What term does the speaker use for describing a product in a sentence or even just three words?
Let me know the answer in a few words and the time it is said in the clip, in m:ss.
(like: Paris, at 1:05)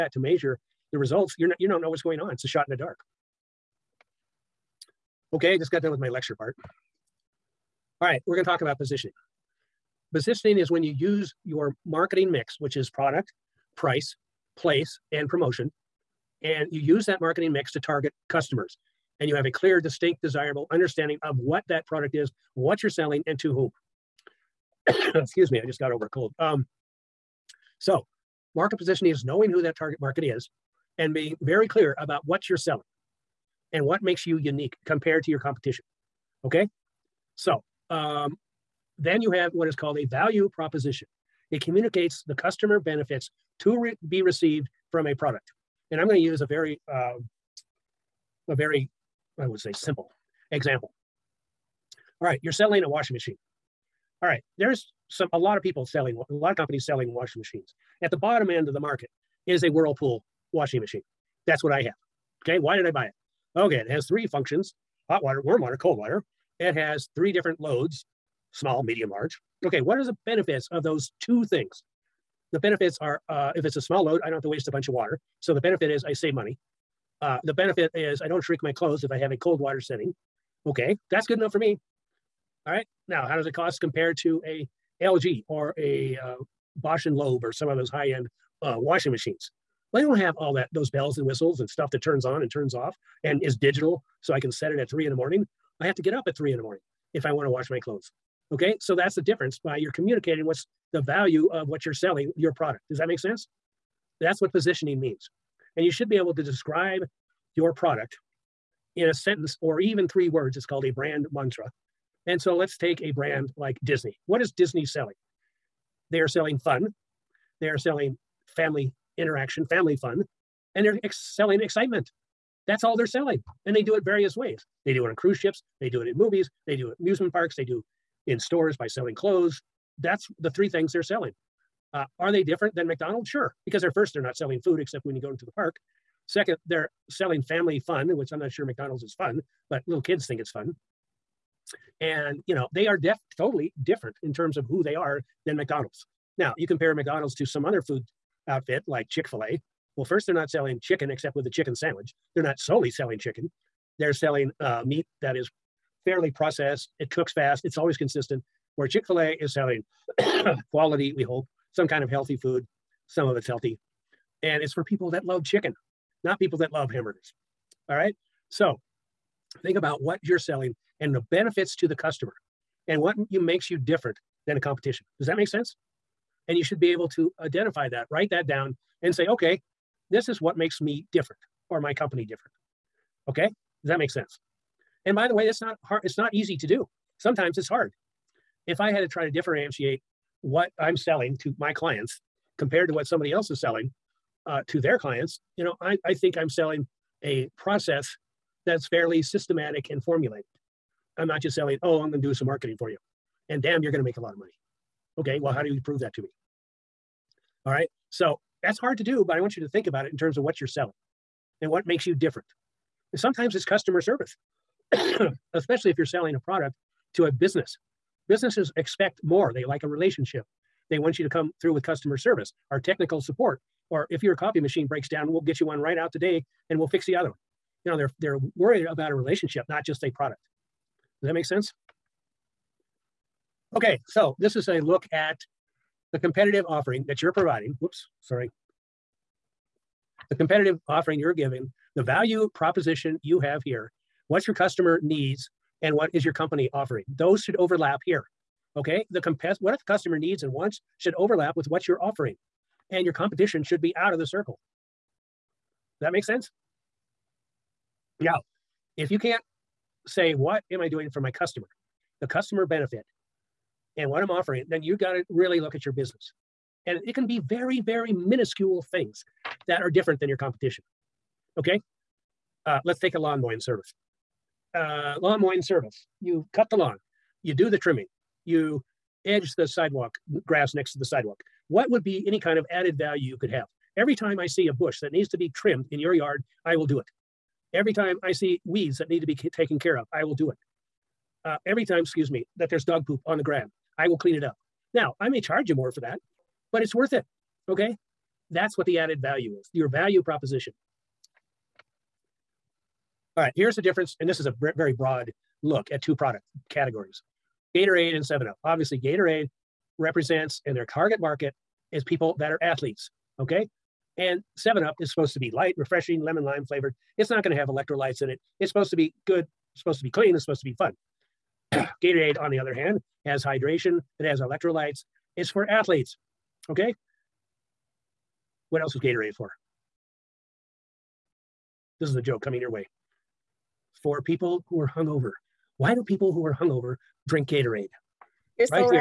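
brand mantra, at 1:50.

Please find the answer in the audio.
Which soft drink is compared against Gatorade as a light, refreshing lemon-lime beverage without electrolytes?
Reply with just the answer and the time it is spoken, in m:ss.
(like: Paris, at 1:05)
7-Up, at 5:08.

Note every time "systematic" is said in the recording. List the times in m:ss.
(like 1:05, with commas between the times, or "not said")
3:19.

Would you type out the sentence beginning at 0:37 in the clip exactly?
So um, then you have what is called a value proposition.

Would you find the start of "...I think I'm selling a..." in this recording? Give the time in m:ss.
3:16.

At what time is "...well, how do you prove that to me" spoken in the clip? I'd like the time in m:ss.
3:25.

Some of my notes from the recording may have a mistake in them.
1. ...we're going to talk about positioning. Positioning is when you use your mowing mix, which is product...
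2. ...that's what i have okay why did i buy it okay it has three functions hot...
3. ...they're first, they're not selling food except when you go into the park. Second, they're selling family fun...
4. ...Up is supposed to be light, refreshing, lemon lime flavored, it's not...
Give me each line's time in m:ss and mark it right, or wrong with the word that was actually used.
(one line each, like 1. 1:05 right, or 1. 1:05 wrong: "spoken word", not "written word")
1. 0:08 wrong: "marketing", not "mowing"
2. 1:01 right
3. 2:13 right
4. 5:14 right.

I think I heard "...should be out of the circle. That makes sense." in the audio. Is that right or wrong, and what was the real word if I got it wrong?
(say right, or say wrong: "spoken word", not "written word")
right.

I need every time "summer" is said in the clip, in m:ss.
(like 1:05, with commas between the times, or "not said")
not said.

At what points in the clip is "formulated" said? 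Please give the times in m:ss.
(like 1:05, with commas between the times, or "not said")
3:20.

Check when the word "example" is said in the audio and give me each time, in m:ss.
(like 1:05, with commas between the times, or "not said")
0:50.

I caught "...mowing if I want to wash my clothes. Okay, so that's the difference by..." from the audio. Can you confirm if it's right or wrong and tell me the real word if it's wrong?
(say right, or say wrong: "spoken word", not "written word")
wrong: "morning", not "mowing".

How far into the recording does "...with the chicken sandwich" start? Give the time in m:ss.
2:31.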